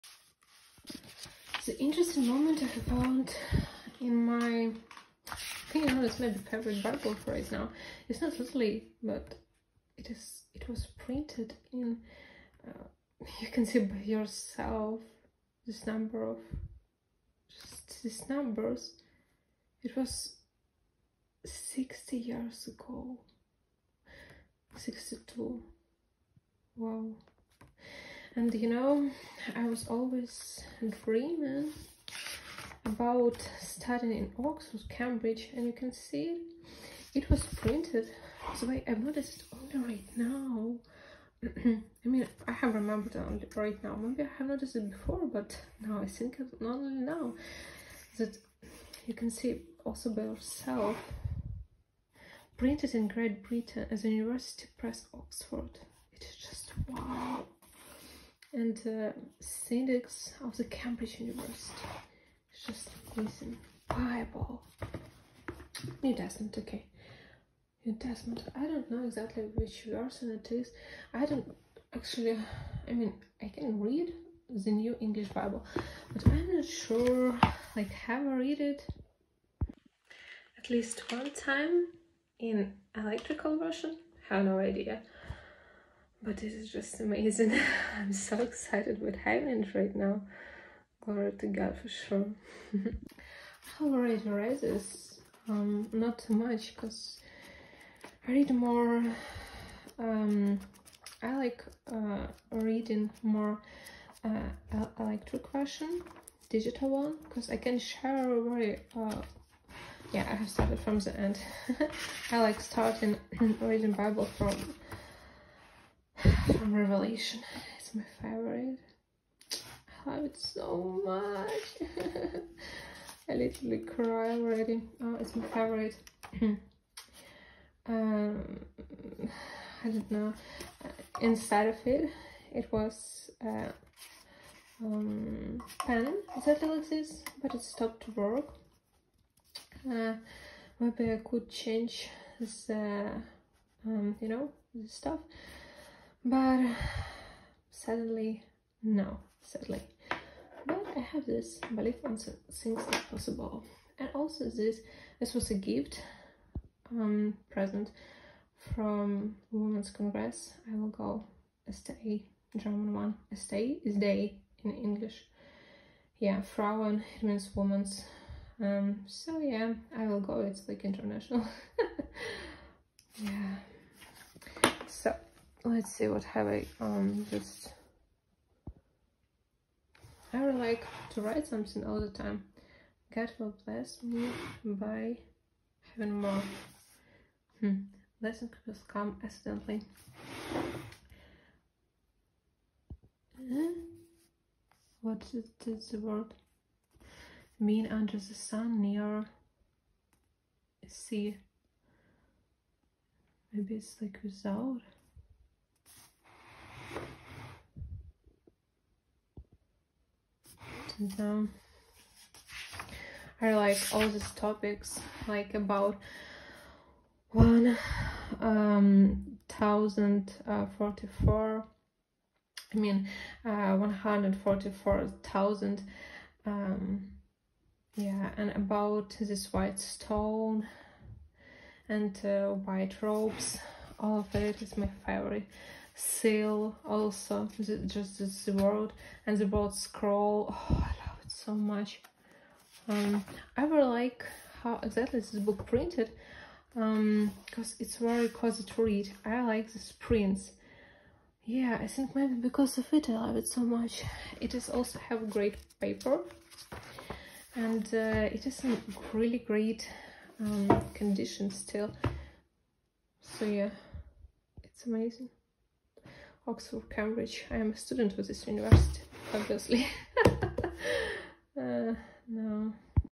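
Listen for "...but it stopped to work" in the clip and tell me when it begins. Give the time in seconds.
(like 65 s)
137 s.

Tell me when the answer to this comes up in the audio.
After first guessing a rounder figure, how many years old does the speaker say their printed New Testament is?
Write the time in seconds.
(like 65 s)
24 s.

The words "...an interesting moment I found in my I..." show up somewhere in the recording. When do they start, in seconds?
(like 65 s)
1 s.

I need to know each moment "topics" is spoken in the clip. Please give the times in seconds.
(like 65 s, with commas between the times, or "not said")
214 s.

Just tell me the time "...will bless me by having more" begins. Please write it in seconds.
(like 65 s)
183 s.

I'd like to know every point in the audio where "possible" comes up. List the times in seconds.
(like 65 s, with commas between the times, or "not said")
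153 s.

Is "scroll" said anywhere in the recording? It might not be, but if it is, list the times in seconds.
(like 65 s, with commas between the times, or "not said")
239 s.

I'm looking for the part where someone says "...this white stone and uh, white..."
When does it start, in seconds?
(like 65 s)
229 s.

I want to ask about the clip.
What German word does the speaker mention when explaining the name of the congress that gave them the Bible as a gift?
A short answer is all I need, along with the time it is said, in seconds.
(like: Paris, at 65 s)
Frauen, at 166 s.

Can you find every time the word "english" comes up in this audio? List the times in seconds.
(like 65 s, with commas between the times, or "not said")
74 s, 164 s.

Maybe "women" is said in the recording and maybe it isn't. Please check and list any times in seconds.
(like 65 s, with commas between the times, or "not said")
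159 s, 167 s.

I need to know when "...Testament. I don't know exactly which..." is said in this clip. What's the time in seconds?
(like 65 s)
67 s.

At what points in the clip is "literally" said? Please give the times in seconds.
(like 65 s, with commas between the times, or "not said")
8 s, 123 s.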